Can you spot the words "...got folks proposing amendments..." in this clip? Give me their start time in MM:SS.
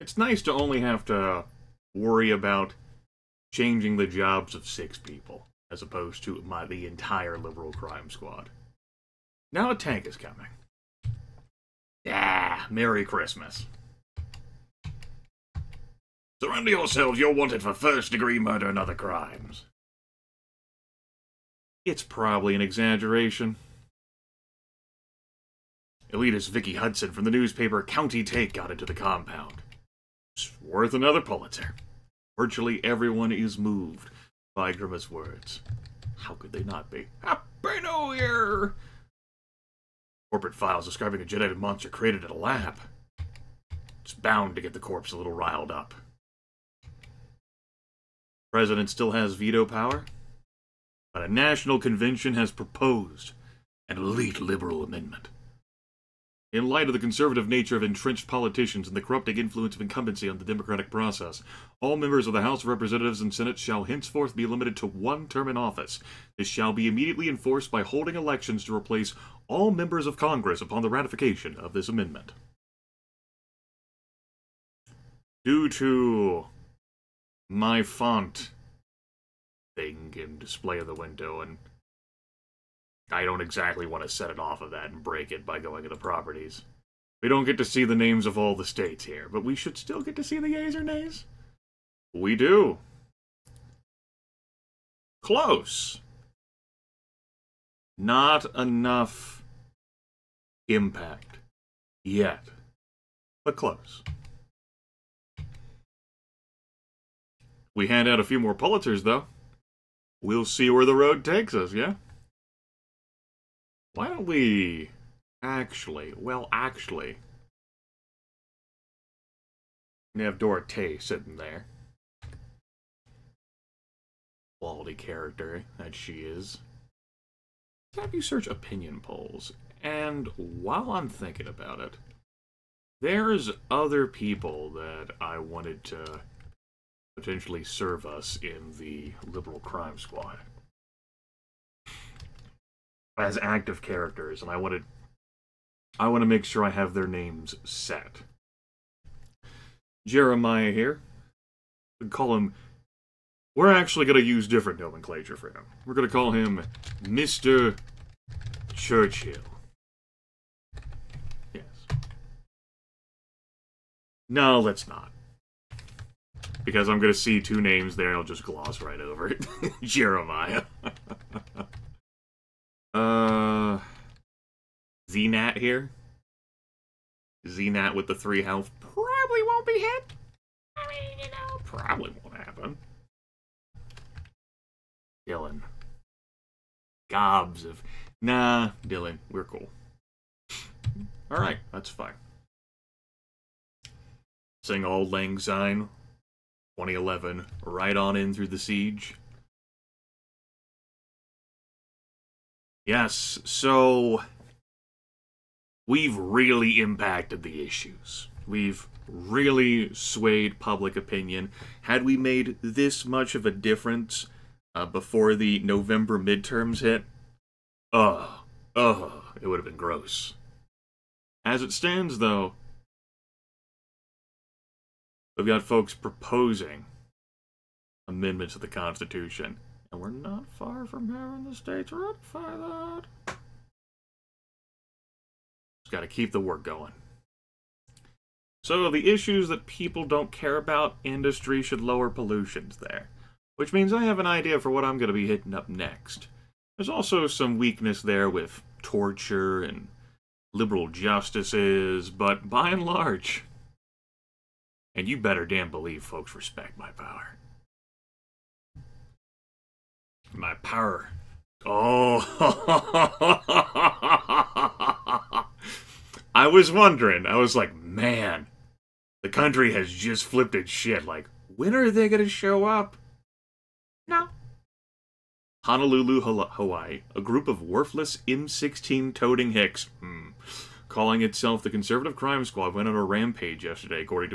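03:45.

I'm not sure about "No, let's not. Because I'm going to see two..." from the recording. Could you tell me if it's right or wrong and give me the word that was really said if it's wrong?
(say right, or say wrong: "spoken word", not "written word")
right.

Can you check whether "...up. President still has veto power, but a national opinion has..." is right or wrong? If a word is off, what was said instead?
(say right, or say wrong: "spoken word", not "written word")
wrong: "convention", not "opinion".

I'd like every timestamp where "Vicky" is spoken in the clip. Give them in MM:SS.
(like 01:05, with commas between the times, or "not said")
00:26.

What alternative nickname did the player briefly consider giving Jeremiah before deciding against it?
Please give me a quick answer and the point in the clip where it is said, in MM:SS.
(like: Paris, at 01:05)
Mister Churchill, at 02:37.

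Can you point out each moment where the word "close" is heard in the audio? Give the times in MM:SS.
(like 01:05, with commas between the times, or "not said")
01:35, 01:43.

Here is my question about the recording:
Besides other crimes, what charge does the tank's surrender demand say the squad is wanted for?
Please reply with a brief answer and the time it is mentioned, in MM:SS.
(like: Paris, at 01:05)
first degree murder, at 00:17.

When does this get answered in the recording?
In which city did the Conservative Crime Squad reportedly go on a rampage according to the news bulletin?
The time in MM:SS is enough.
04:35.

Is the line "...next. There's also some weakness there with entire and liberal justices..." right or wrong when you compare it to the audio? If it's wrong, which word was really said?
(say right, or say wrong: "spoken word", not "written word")
wrong: "torture", not "entire".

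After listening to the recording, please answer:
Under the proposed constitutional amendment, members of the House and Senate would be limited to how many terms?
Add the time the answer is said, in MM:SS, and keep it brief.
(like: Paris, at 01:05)
one term, at 01:04.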